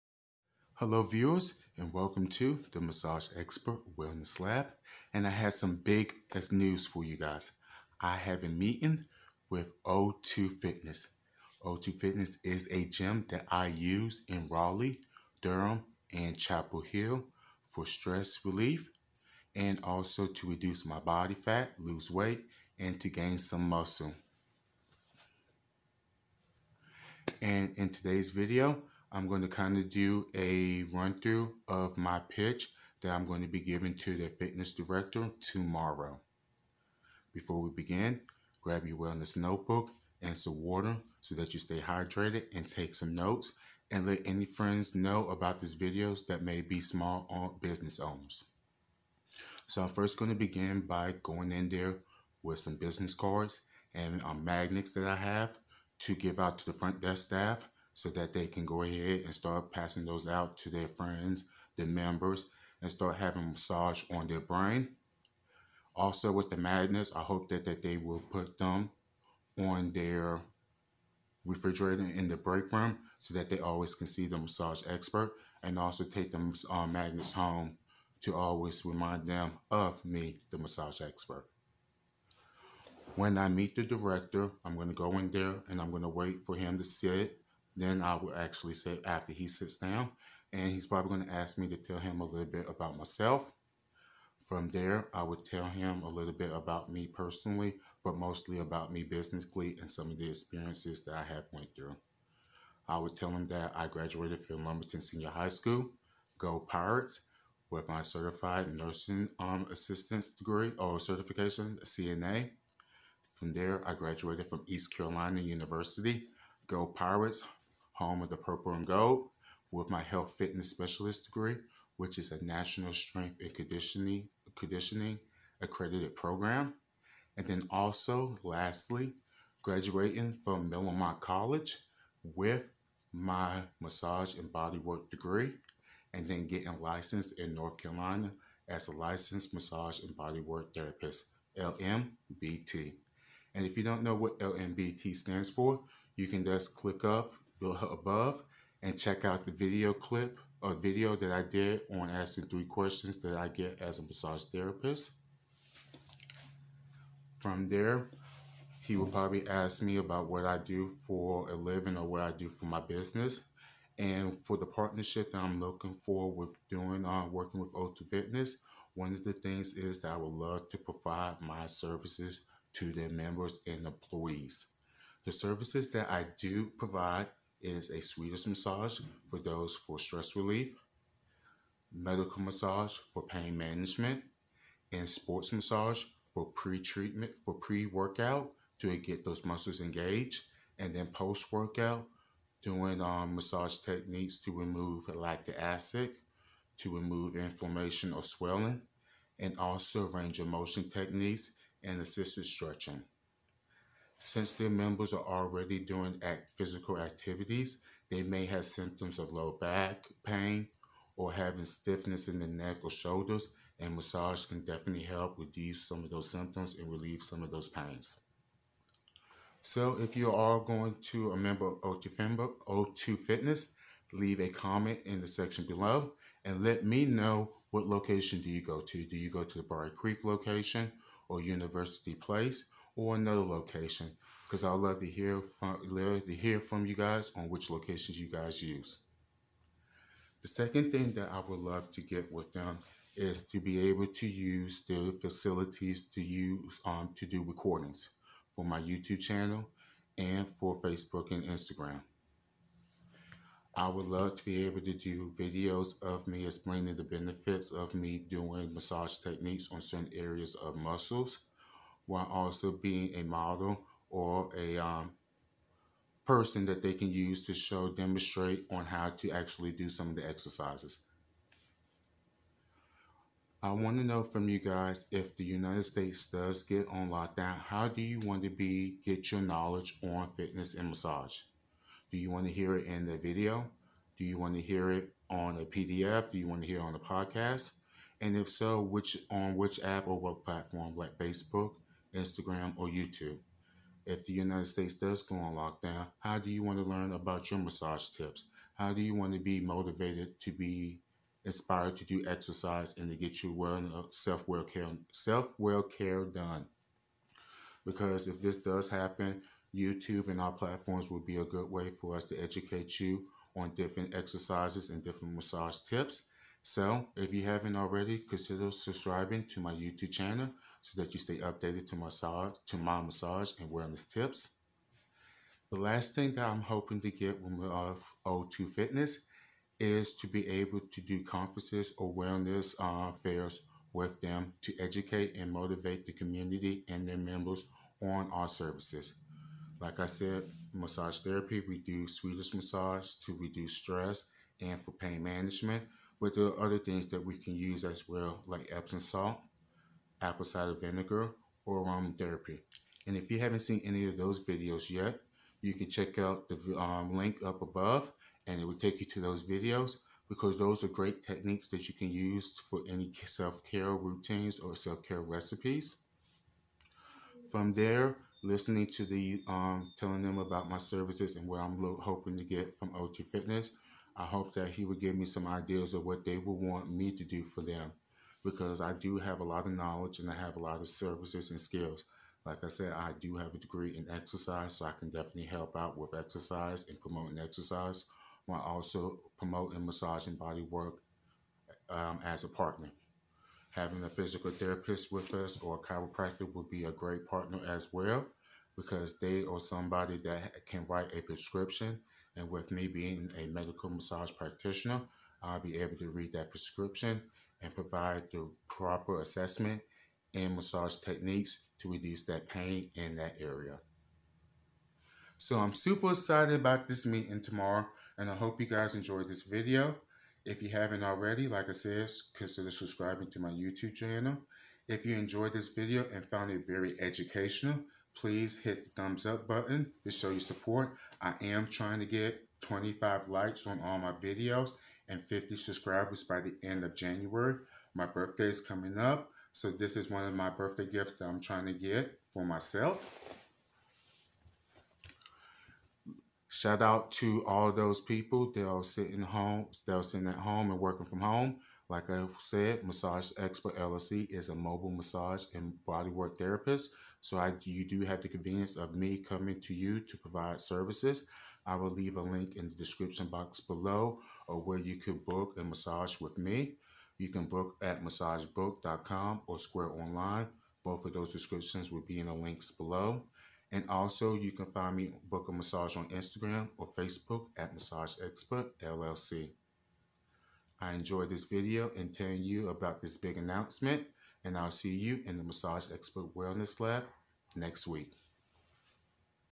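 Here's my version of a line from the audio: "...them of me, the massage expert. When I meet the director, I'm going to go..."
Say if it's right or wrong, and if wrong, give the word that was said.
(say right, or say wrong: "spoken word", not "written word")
right.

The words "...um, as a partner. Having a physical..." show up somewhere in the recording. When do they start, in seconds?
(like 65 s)
391 s.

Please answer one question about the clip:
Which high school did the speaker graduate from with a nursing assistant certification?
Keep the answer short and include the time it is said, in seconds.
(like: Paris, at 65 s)
Lumberton Senior High School, at 104 s.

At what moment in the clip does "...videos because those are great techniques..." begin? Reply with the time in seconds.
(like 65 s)
359 s.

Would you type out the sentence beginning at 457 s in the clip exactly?
So I, you do have the convenience of me coming to you to provide services.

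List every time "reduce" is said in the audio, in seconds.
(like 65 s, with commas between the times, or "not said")
20 s, 215 s, 343 s, 411 s.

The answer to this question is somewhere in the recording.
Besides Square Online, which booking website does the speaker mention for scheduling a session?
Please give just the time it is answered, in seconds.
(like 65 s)
468 s.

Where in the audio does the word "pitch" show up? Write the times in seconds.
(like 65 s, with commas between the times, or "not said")
32 s.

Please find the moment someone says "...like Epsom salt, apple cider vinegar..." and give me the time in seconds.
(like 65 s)
348 s.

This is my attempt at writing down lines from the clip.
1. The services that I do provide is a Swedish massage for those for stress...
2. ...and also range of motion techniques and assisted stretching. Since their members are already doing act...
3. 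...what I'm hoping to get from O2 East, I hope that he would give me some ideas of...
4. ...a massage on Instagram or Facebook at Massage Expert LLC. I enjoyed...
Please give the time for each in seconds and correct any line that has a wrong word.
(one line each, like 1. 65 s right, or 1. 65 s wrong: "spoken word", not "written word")
1. 175 s right
2. 199 s right
3. 371 s wrong: "Fitness", not "East"
4. 475 s right.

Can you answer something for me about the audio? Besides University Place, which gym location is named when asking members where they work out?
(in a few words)
Brier Creek.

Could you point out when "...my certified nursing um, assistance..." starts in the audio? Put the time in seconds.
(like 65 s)
107 s.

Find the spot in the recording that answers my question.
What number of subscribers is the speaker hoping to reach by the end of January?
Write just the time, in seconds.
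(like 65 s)
435 s.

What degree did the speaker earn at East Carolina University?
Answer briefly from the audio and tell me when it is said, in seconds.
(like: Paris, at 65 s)
Health fitness specialist, at 120 s.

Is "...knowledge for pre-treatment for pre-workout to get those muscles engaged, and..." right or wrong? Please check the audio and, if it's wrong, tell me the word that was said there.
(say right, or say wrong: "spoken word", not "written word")
wrong: "massage", not "knowledge".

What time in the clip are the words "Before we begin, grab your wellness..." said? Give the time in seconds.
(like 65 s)
37 s.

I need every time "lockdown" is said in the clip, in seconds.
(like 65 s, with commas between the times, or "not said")
277 s, 295 s.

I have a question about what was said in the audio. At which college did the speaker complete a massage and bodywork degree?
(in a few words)
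Miller-Motte College.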